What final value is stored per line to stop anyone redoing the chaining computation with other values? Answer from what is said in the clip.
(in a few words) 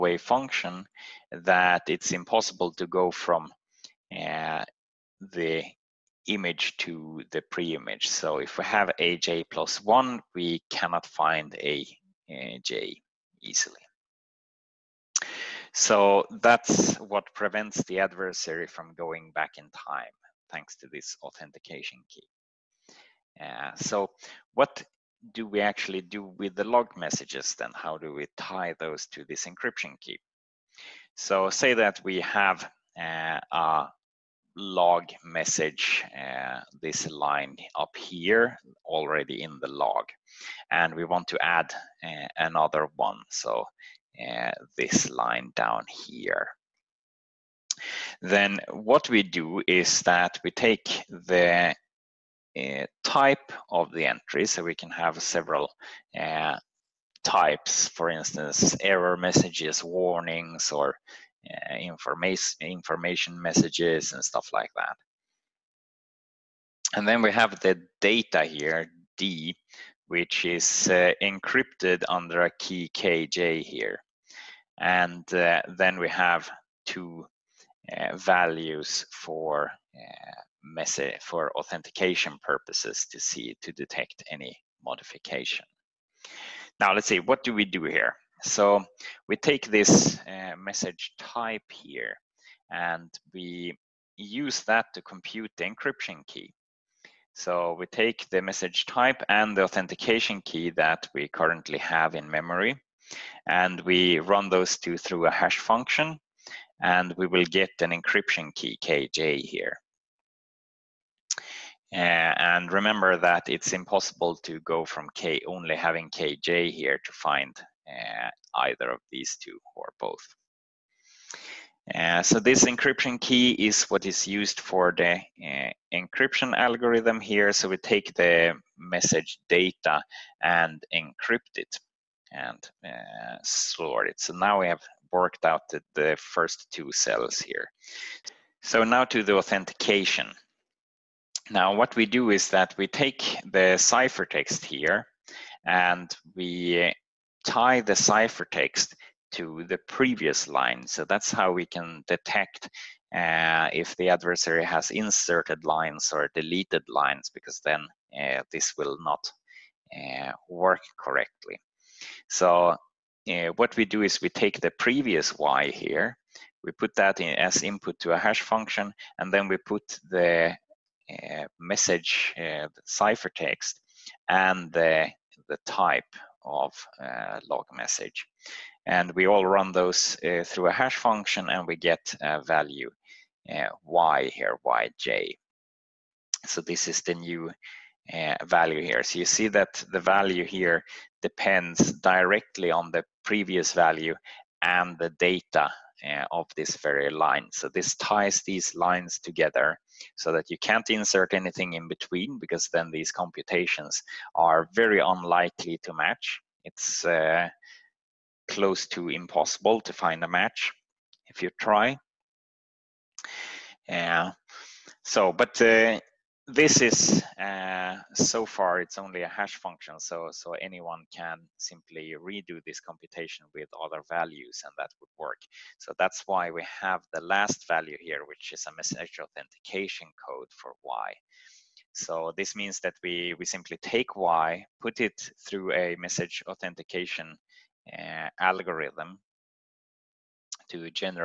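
message authentication code.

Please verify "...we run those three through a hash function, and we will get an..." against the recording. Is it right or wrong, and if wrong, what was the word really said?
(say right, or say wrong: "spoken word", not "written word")
wrong: "two", not "three".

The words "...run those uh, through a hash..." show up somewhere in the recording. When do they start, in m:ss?
2:59.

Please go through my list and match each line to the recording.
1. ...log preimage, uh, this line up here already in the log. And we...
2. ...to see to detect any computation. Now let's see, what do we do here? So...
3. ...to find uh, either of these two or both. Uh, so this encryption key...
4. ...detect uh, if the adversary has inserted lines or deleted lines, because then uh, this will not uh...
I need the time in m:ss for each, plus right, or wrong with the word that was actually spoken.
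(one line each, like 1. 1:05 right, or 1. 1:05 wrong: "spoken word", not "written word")
1. 0:34 wrong: "message", not "preimage"
2. 1:23 wrong: "modification", not "computation"
3. 1:57 right
4. 2:32 right.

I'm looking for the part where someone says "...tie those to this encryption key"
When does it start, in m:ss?
0:28.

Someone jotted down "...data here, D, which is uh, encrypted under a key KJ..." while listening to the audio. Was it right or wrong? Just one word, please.
right.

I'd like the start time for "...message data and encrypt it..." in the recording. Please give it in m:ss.
2:08.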